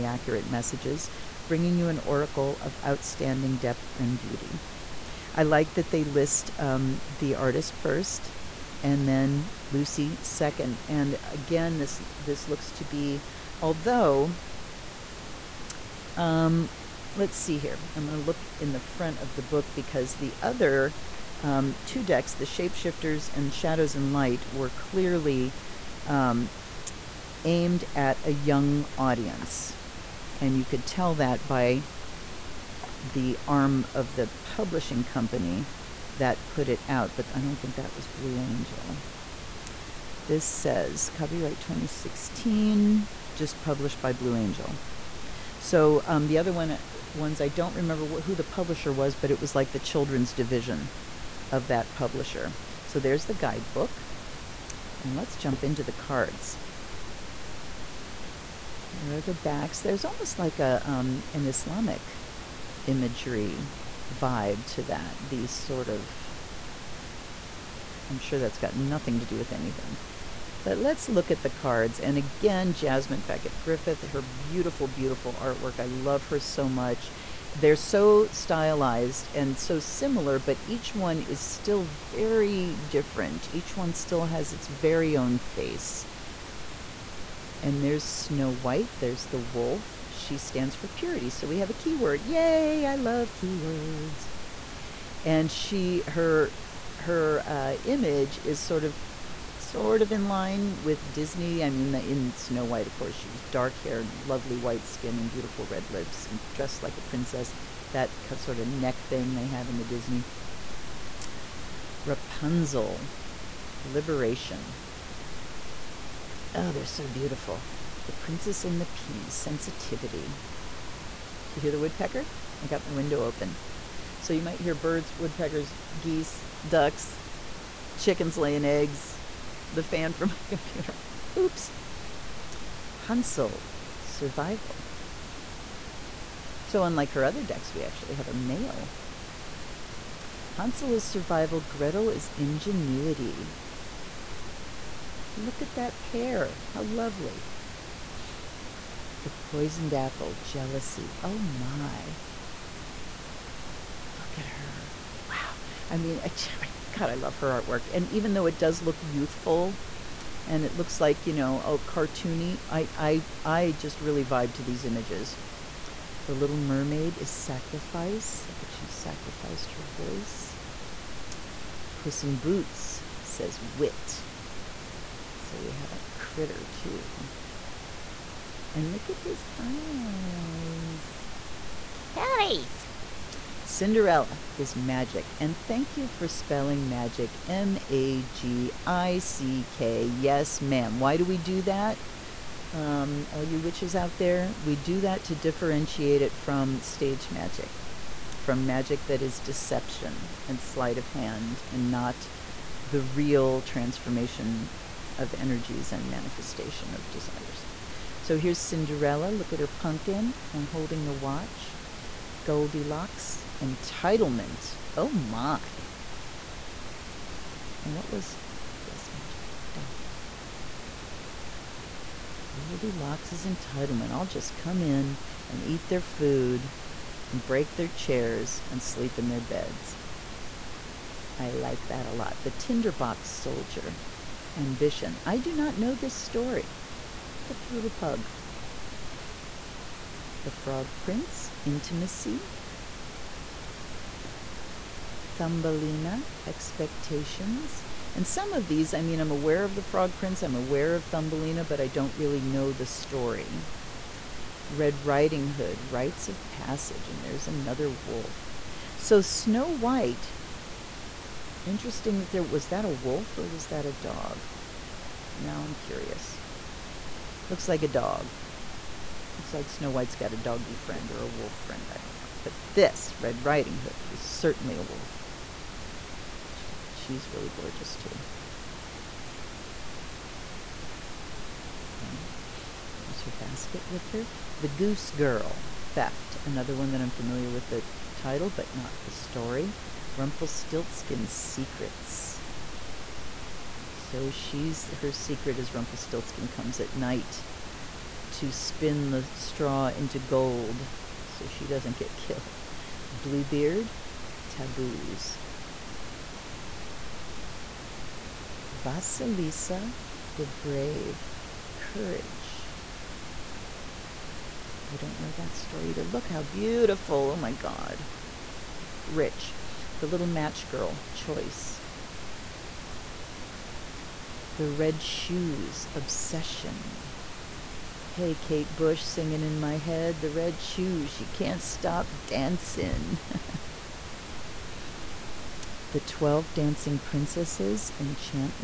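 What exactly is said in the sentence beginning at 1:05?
These sort of I'm sure that's got nothing to do with anything.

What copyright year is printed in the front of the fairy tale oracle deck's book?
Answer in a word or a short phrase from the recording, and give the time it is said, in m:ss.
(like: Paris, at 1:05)
2016, at 0:41.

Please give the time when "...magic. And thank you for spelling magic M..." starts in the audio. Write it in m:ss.
3:04.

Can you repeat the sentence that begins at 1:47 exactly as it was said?
That sort of neck thing they have in the Disney.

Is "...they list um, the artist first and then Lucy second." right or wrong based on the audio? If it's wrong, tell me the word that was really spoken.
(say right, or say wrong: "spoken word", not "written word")
right.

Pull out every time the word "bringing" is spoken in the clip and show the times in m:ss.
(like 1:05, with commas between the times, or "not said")
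0:01.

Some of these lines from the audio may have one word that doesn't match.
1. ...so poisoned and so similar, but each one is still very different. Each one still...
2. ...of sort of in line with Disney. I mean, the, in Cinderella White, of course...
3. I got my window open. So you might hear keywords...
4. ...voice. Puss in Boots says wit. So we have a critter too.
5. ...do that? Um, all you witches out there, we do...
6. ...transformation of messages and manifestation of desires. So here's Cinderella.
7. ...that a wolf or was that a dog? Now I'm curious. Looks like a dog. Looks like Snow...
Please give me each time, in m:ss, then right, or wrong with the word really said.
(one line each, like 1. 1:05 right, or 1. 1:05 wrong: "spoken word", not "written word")
1. 1:17 wrong: "stylized", not "poisoned"
2. 1:38 wrong: "Snow", not "Cinderella"
3. 2:02 wrong: "birds", not "keywords"
4. 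2:49 right
5. 3:11 right
6. 3:23 wrong: "energies", not "messages"
7. 4:22 right.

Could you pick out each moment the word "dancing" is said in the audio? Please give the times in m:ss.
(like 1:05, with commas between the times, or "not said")
5:32, 5:36.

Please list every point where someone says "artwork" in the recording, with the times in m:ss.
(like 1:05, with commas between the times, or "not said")
1:15, 2:37.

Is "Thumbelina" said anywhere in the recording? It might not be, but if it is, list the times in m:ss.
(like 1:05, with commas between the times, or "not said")
4:05, 4:11.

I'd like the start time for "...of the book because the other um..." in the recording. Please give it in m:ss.
0:19.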